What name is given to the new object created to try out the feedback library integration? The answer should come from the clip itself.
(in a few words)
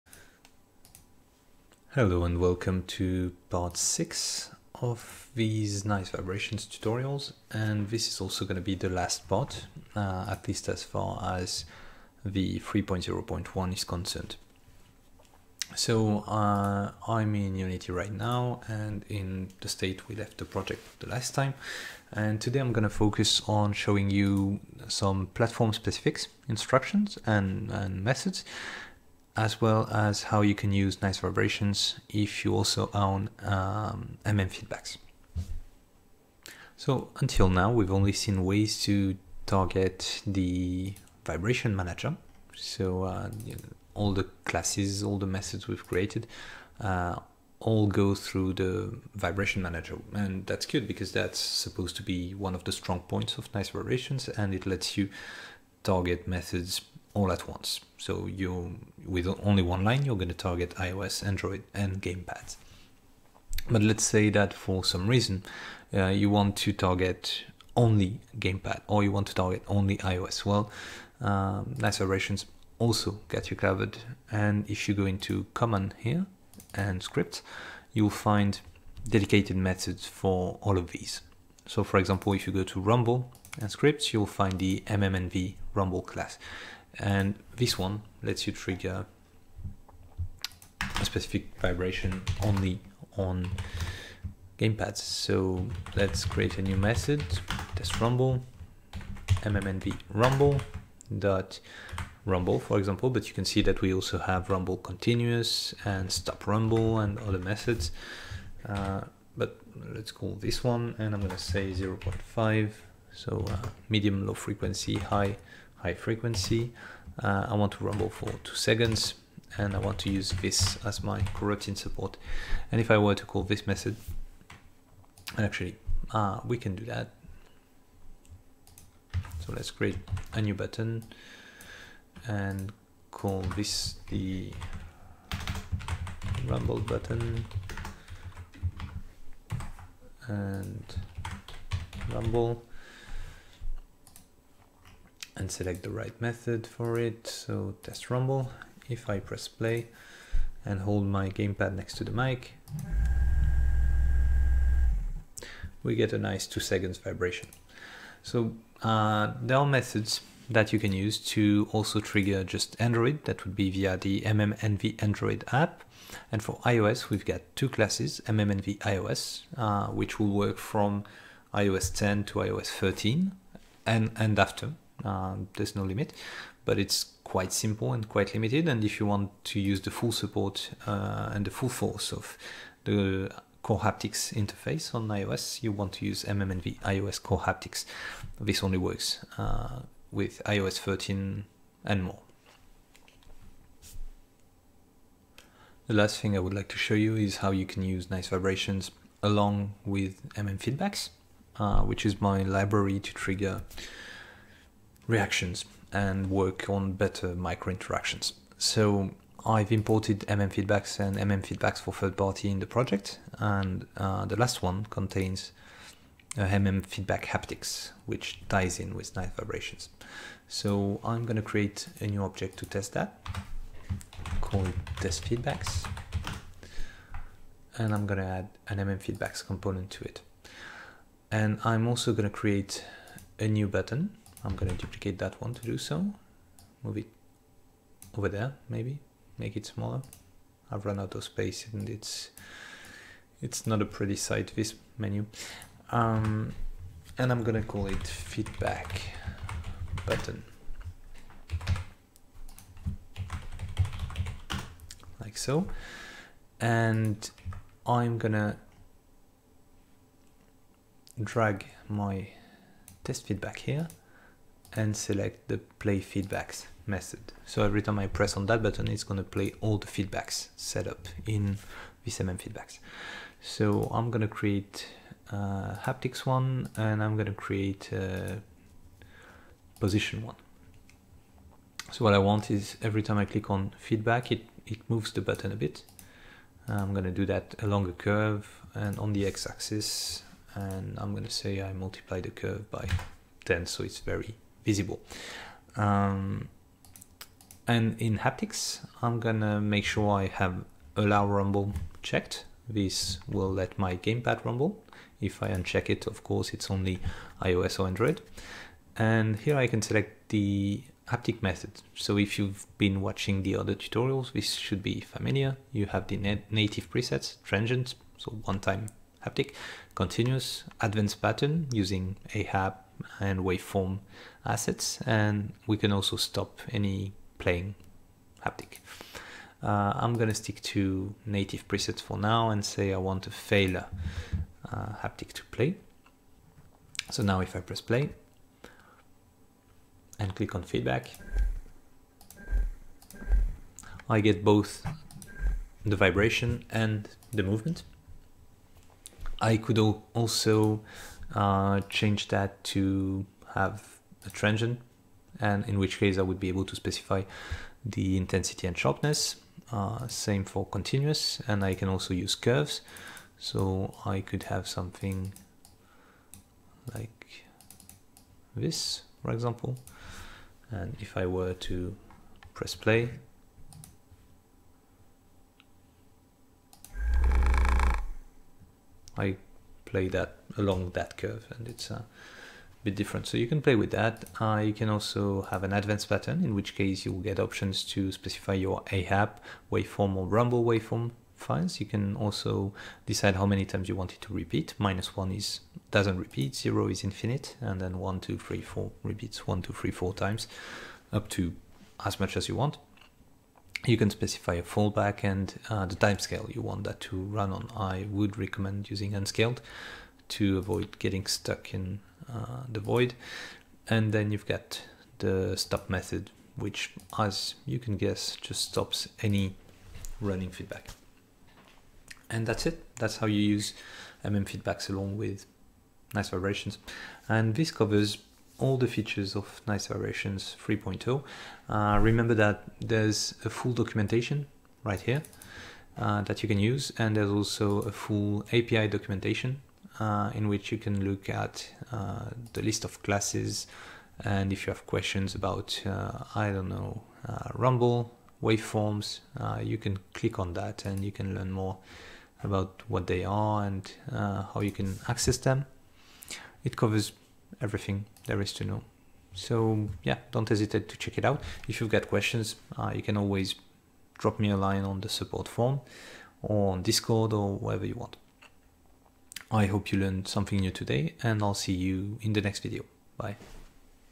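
test feedbacks.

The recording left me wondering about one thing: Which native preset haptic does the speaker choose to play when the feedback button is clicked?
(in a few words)
failure.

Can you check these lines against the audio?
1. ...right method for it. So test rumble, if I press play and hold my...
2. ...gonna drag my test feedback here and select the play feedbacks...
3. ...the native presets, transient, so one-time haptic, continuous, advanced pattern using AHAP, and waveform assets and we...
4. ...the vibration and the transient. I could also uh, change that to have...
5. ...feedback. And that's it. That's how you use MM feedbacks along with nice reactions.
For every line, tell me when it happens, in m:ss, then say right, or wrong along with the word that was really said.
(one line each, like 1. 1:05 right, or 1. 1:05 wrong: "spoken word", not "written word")
1. 2:25 right
2. 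4:18 right
3. 5:16 right
4. 5:45 wrong: "movement", not "transient"
5. 7:00 wrong: "vibrations", not "reactions".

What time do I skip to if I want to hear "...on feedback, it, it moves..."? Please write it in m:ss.
4:43.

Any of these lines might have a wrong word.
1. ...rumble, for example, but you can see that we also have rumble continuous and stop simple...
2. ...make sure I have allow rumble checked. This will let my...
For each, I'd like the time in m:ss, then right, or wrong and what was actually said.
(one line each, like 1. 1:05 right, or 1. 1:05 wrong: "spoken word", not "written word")
1. 1:42 wrong: "rumble", not "simple"
2. 4:59 right.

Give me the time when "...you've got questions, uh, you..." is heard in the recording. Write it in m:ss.
7:41.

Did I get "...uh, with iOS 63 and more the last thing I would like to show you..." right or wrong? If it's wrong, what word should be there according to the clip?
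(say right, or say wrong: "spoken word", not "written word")
wrong: "13", not "63".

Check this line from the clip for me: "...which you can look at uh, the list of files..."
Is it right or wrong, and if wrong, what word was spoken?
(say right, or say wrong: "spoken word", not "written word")
wrong: "classes", not "files".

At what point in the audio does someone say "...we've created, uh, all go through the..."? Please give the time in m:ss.
0:45.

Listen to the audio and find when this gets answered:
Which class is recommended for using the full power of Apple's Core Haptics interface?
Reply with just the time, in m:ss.
3:06.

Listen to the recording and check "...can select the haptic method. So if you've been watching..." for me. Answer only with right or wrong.
right.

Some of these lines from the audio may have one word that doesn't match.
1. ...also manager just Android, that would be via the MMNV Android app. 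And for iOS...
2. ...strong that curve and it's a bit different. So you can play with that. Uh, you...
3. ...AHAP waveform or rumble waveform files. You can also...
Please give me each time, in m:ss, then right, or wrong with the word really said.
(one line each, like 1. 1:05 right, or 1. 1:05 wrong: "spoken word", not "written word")
1. 2:41 wrong: "trigger", not "manager"
2. 6:20 wrong: "along", not "strong"
3. 6:28 right.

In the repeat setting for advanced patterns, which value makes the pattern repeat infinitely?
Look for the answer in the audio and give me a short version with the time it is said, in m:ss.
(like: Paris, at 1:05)
0, at 6:36.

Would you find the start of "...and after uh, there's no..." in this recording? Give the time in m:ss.
2:54.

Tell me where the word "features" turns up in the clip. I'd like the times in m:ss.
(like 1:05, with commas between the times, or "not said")
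7:08.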